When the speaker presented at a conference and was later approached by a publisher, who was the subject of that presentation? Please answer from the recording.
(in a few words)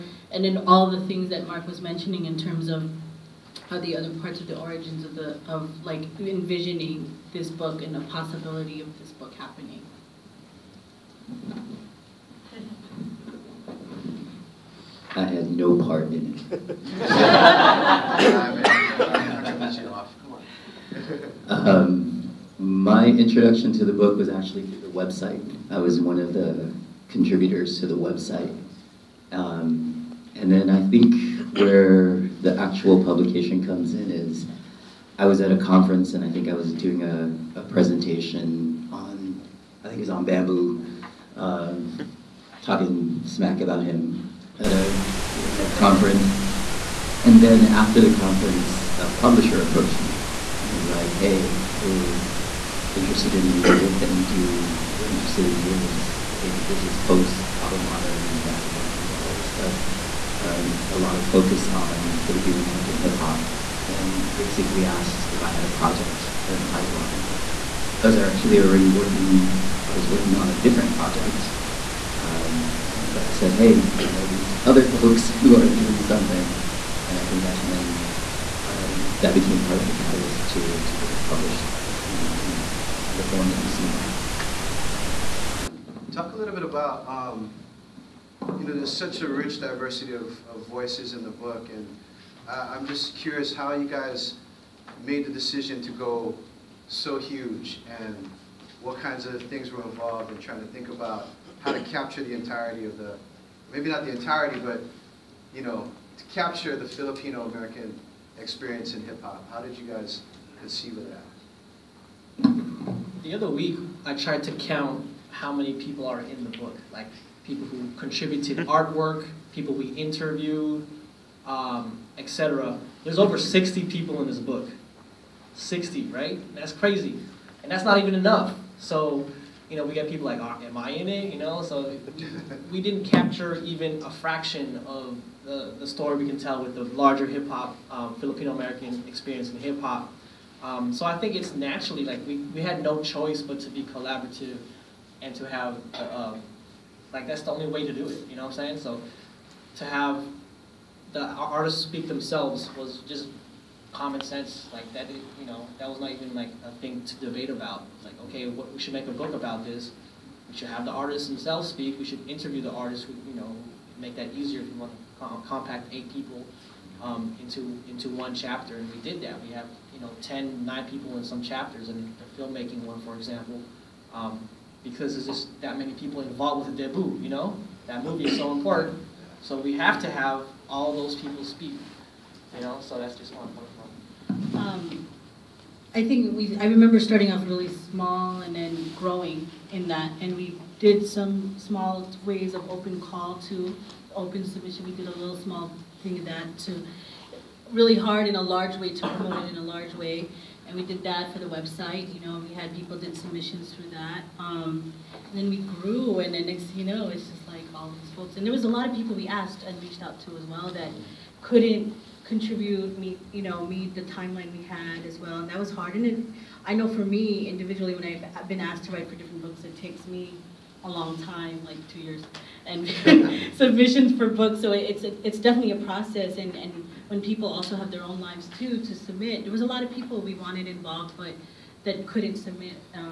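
Bambu.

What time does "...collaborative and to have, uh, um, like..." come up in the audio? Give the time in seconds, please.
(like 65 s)
143 s.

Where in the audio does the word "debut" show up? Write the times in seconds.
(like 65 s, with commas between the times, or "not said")
176 s.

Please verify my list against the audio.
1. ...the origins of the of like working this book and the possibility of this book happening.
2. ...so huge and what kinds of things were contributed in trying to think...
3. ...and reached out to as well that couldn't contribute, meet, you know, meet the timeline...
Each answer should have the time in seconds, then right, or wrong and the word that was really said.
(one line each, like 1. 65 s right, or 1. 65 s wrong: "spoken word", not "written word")
1. 4 s wrong: "envisioning", not "working"
2. 96 s wrong: "involved", not "contributed"
3. 209 s right.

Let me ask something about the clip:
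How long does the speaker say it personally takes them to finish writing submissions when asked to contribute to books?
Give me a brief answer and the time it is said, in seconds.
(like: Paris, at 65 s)
2 years, at 221 s.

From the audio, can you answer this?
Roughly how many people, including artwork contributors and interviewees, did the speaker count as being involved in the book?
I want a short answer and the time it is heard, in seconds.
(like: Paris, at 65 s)
60, at 123 s.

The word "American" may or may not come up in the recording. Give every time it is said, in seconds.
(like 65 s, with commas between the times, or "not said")
62 s, 106 s, 138 s.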